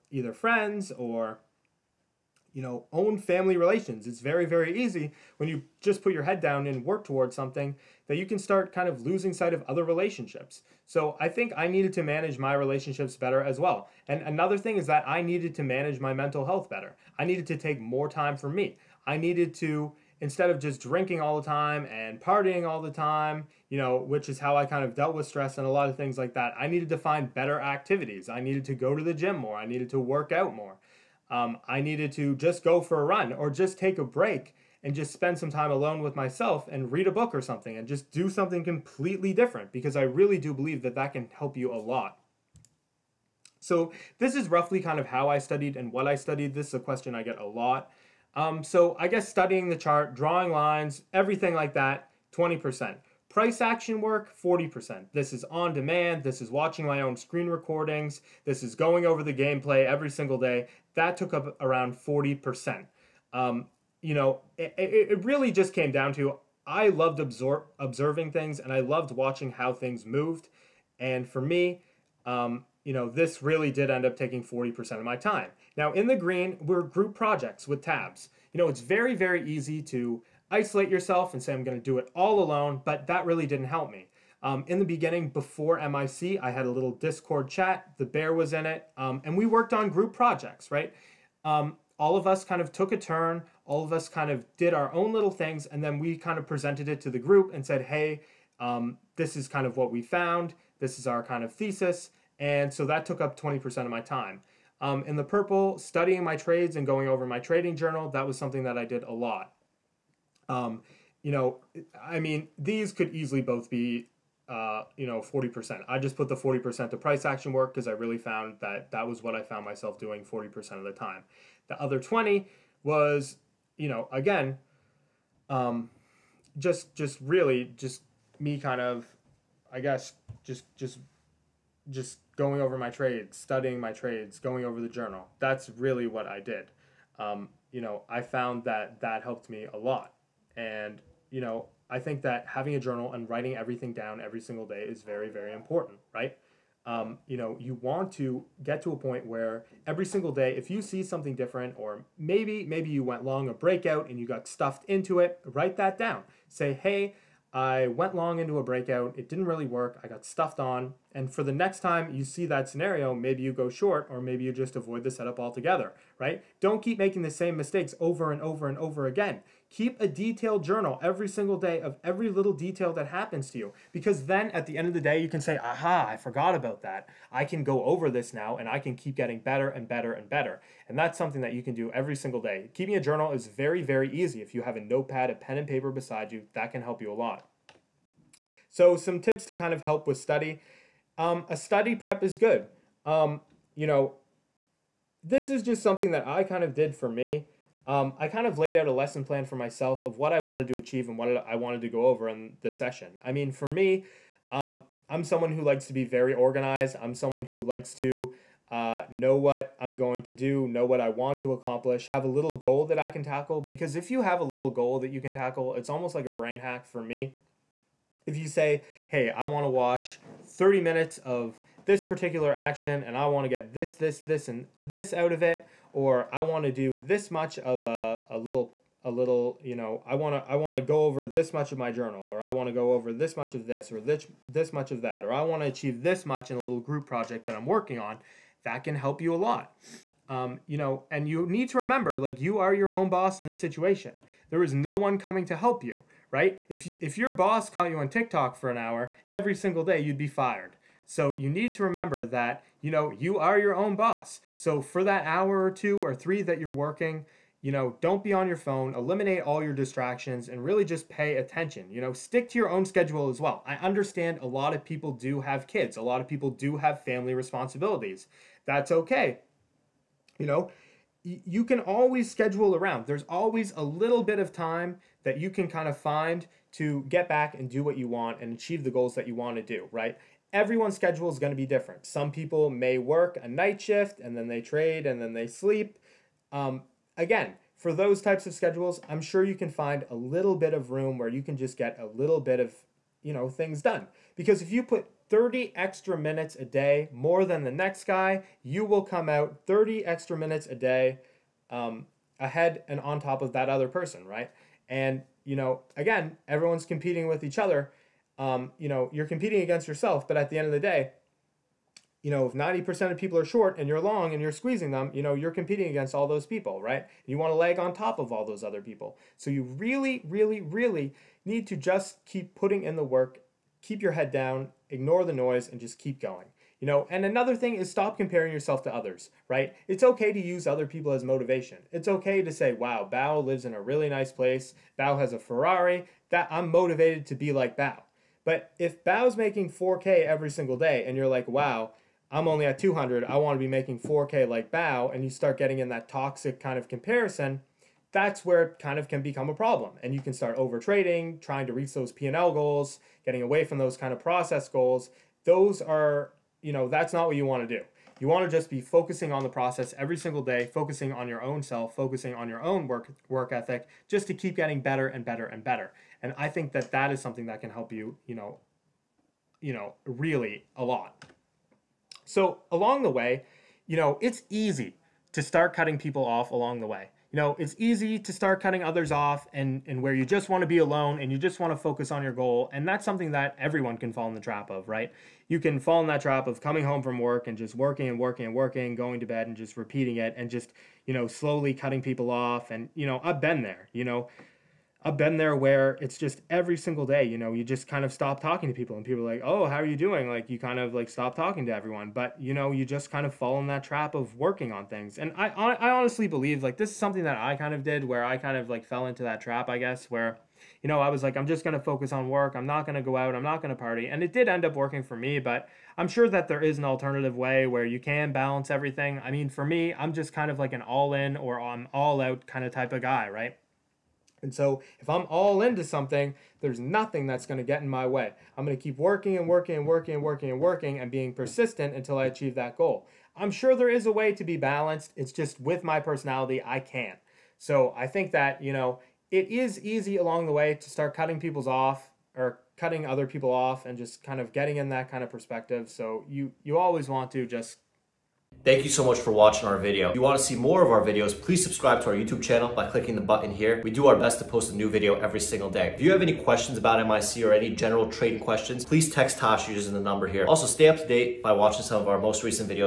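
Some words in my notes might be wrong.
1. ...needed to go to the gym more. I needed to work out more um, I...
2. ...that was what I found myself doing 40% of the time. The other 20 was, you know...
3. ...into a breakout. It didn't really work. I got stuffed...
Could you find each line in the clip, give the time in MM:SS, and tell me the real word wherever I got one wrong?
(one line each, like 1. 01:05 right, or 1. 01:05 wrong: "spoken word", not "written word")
1. 00:28 right
2. 01:58 right
3. 02:38 right.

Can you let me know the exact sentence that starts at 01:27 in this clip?
The bear was in it, um, and we worked on group projects, right?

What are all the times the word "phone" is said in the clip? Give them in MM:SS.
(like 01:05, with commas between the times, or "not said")
04:18.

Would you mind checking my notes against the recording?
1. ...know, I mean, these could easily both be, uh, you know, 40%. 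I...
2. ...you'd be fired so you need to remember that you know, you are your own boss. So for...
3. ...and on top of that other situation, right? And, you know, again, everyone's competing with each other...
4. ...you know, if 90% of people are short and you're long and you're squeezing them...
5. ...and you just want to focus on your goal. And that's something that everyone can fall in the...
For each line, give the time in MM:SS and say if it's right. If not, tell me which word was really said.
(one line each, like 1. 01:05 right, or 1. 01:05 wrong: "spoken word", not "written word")
1. 01:51 right
2. 04:09 right
3. 05:02 wrong: "person", not "situation"
4. 05:12 right
5. 06:21 right.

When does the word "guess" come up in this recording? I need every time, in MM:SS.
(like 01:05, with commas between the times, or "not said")
00:49, 02:09, 06:49.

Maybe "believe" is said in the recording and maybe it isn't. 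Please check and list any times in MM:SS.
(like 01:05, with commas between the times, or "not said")
00:40, 06:46.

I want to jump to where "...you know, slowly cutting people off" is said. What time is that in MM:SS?
06:31.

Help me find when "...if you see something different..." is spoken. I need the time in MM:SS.
02:30.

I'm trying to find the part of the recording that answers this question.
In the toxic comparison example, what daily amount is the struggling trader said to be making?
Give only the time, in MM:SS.
05:42.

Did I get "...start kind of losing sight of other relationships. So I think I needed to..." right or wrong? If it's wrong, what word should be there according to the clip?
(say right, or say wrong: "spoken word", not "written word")
right.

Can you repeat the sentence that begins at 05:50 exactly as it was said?
And you can start over trading, trying to reach those P&L goals, getting away from those kind of process goals.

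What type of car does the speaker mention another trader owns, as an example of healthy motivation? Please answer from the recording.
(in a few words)
Ferrari.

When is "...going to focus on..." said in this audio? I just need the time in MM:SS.
06:51.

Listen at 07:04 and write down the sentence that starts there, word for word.
And so if I'm all into something, there's nothing that's going to get in my way.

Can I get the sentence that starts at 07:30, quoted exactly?
If you want to see more of our videos, please subscribe to our YouTube channel by clicking the button here.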